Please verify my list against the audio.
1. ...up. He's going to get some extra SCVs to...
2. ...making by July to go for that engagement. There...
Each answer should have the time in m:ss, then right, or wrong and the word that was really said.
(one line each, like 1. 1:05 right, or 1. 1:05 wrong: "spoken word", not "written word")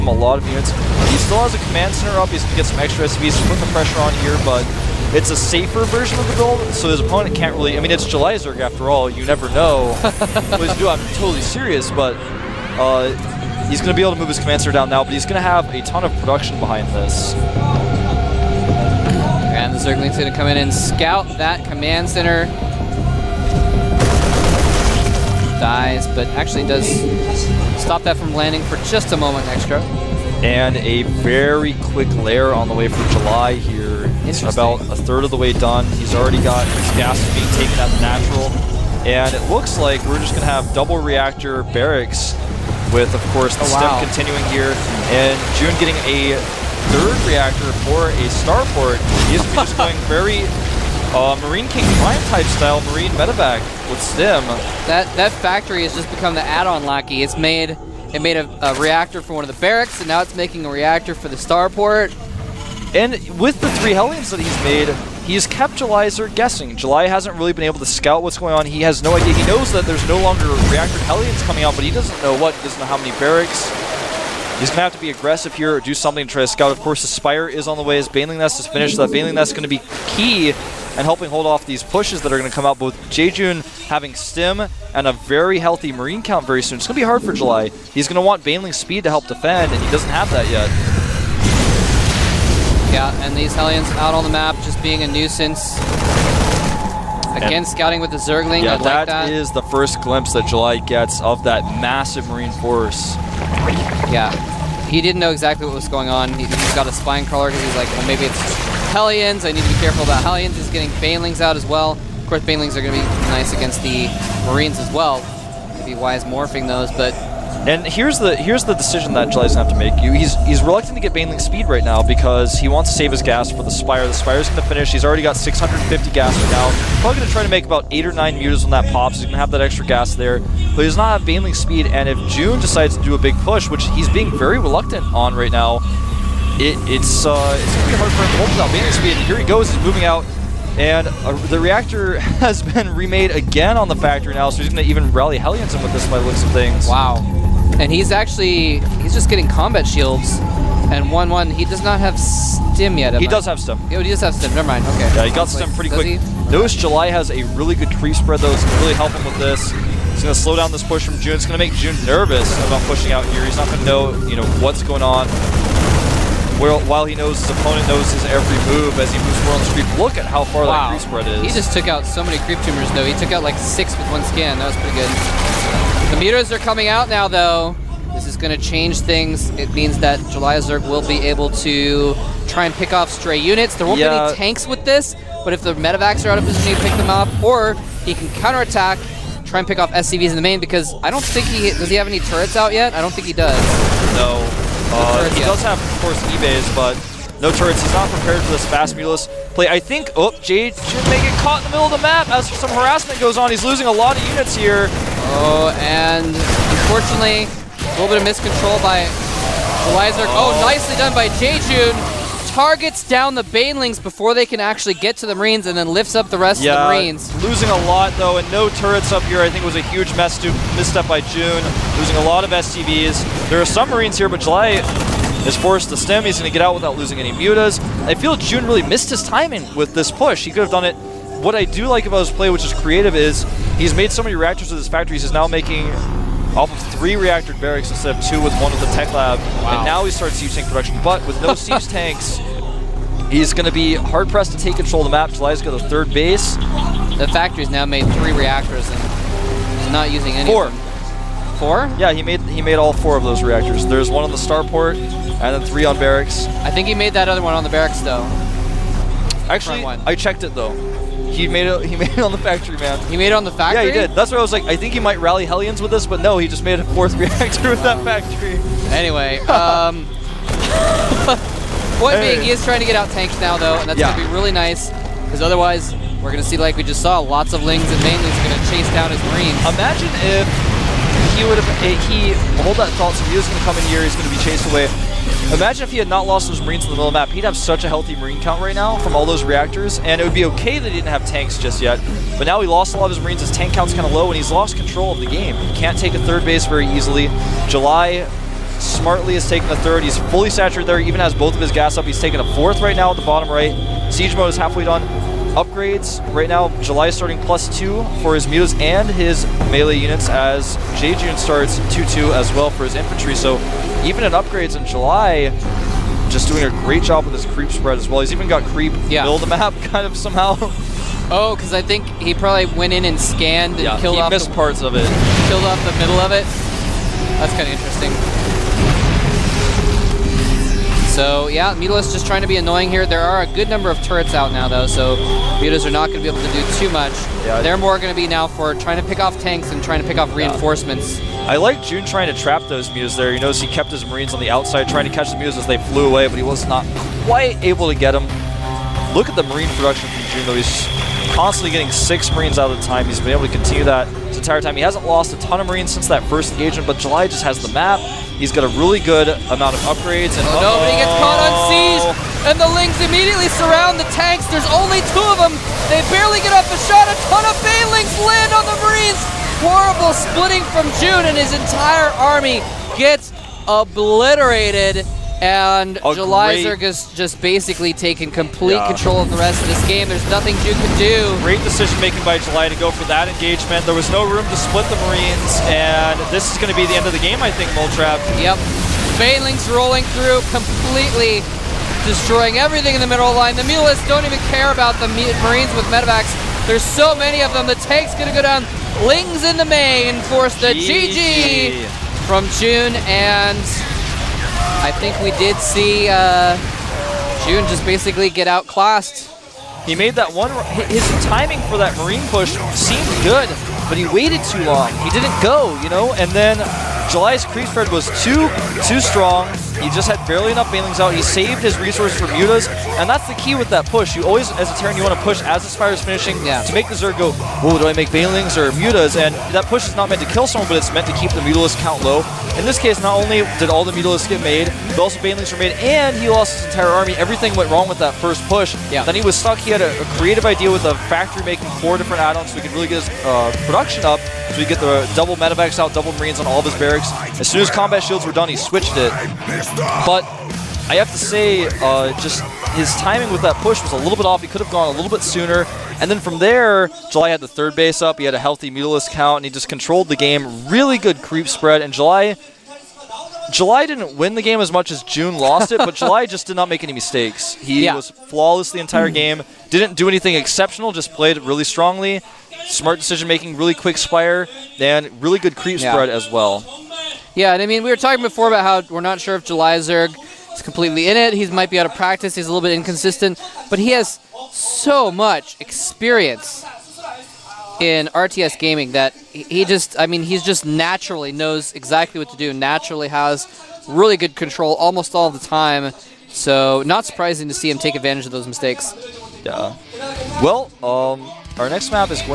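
1. 0:02 right
2. 6:22 right.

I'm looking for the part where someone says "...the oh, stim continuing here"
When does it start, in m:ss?
0:43.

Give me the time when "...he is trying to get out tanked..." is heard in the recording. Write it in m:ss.
4:32.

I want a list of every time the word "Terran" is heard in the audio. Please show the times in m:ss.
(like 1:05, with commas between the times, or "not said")
7:04.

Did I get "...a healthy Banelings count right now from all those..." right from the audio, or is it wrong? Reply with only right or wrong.
wrong.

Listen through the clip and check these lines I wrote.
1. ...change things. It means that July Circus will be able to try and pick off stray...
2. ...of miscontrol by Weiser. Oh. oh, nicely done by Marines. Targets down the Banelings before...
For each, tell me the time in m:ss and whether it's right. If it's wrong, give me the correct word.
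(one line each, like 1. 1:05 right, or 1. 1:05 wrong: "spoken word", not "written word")
1. 2:58 wrong: "Zerg", not "Circus"
2. 3:28 wrong: "Jejun", not "Marines".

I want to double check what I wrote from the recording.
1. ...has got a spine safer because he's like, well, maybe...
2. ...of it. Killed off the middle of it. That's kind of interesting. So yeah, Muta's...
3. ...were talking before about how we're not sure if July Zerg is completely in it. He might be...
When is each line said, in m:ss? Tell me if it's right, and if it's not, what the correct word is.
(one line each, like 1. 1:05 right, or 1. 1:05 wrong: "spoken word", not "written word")
1. 1:46 wrong: "crawler", not "safer"
2. 5:24 right
3. 7:57 right.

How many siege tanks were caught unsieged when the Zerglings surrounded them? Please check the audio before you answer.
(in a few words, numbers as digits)
2.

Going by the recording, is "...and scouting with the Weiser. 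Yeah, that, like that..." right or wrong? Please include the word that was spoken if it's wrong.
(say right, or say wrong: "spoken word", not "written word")
wrong: "Zergling", not "Weiser".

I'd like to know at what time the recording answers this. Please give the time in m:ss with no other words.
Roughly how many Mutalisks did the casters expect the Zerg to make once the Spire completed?
2:07.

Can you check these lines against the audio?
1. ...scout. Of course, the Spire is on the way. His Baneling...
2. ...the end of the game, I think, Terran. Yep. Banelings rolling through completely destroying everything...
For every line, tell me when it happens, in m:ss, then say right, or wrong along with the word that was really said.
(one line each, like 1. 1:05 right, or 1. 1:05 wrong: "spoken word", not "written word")
1. 1:16 right
2. 6:26 wrong: "Moletrap", not "Terran".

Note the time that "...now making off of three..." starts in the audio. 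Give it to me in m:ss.
3:55.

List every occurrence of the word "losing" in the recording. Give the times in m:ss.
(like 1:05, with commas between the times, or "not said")
3:23, 3:37, 3:41, 3:46.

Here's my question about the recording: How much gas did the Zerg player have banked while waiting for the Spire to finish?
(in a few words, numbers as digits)
650.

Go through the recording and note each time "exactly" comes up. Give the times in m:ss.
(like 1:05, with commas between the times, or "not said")
1:45, 8:11.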